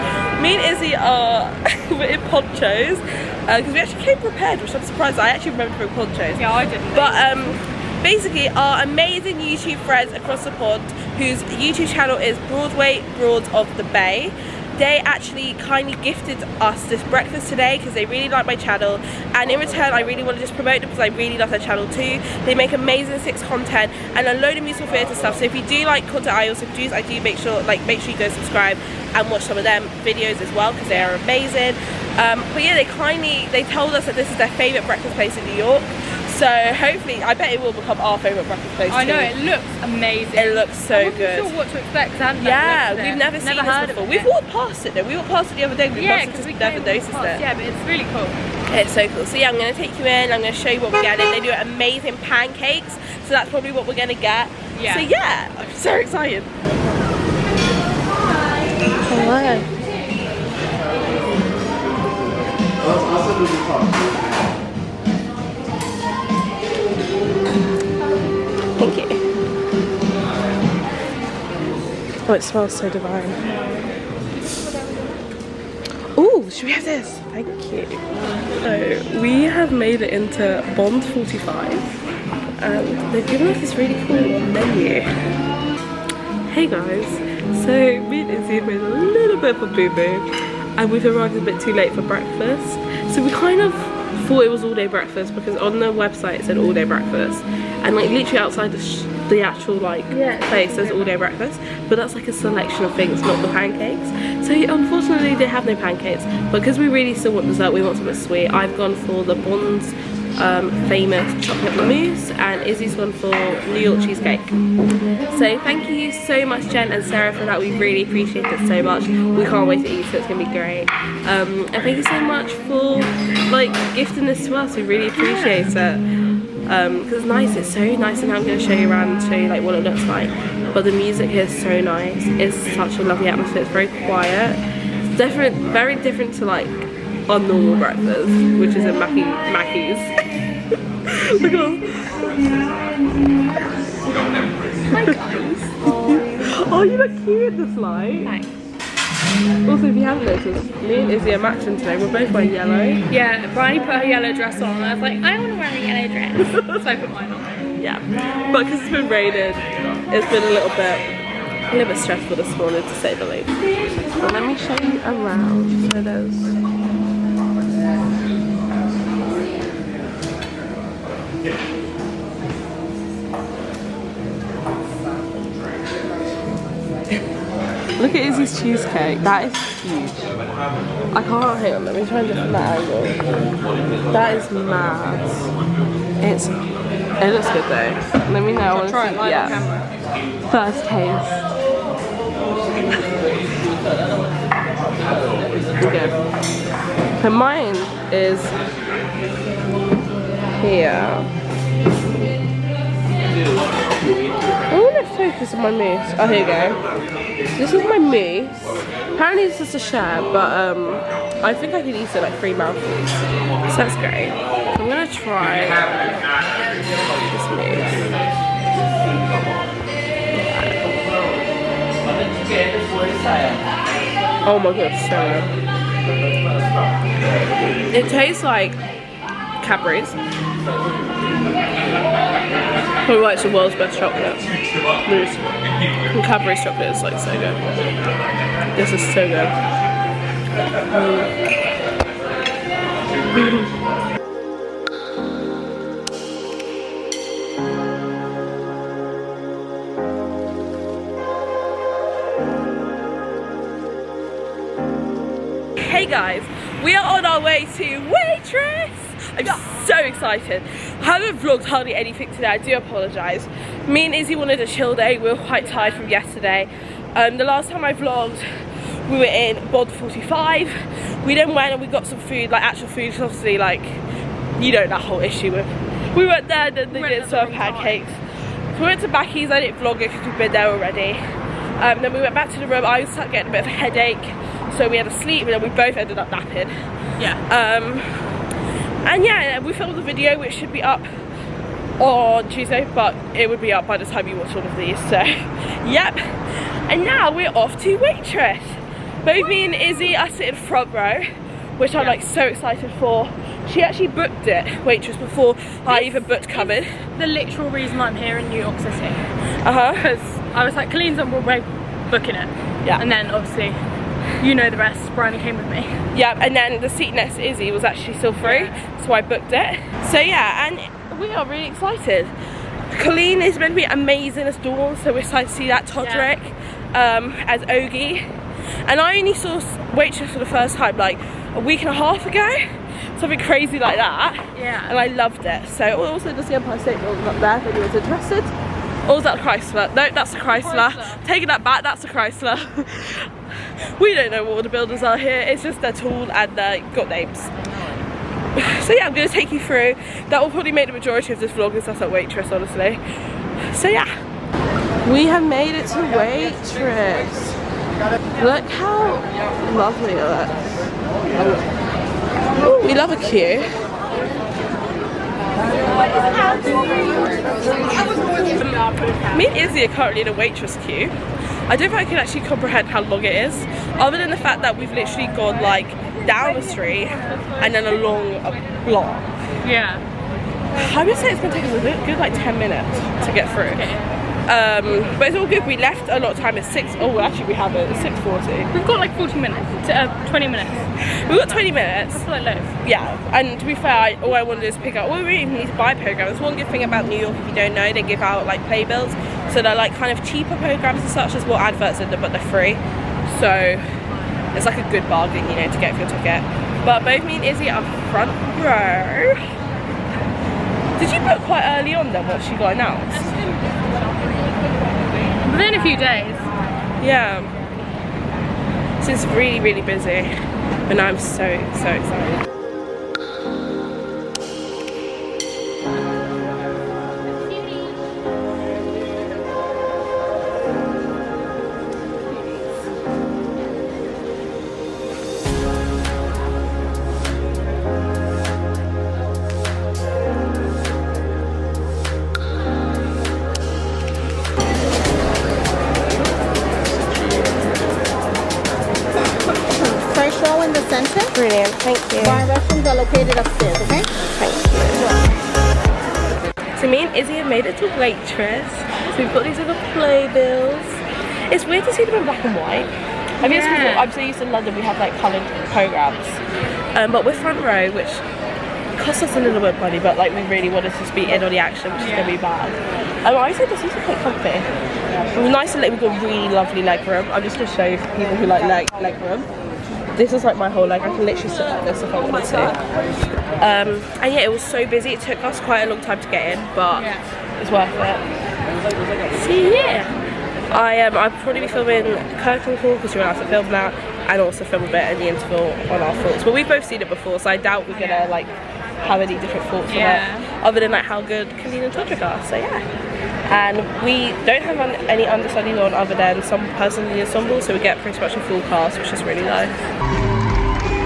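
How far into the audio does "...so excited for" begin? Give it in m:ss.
5:02.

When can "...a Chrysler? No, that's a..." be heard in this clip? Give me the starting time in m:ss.
5:39.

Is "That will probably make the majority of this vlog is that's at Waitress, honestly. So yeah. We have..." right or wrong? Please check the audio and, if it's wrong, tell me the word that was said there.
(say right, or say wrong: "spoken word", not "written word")
right.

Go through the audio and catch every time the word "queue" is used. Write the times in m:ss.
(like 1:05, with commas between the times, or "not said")
6:03, 6:10.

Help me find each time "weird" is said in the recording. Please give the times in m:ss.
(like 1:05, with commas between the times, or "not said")
7:41.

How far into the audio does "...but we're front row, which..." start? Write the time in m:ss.
7:47.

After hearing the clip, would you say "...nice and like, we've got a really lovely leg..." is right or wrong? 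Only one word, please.
right.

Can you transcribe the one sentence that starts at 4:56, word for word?
And now we're off to Waitress.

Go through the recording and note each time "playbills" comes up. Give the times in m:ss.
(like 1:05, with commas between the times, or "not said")
6:38, 7:39.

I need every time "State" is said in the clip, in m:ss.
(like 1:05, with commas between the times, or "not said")
5:36.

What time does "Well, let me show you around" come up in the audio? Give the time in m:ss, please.
2:43.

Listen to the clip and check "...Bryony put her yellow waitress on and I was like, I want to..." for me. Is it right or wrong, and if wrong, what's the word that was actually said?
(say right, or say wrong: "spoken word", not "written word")
wrong: "dress", not "waitress".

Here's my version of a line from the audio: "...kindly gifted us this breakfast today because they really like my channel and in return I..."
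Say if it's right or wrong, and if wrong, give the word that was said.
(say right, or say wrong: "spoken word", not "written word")
right.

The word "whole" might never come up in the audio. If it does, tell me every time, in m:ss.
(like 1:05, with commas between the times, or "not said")
4:35, 8:00.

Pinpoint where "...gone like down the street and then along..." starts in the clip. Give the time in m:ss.
6:15.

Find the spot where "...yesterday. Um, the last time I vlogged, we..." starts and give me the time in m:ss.
4:26.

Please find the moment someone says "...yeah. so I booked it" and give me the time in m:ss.
5:18.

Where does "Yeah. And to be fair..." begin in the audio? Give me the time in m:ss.
6:32.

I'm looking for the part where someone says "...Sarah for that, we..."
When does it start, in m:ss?
1:57.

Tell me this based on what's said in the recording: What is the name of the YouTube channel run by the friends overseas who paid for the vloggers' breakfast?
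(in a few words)
Broadway Broads of the Bay.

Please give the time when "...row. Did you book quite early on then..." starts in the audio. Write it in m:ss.
6:48.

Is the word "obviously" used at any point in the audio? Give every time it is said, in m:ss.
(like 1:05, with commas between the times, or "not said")
4:33, 5:13.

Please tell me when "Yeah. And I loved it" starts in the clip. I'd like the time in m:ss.
5:34.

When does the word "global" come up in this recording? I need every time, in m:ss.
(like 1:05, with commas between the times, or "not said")
not said.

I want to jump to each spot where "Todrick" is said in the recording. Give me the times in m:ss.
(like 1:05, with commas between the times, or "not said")
5:25, 8:21.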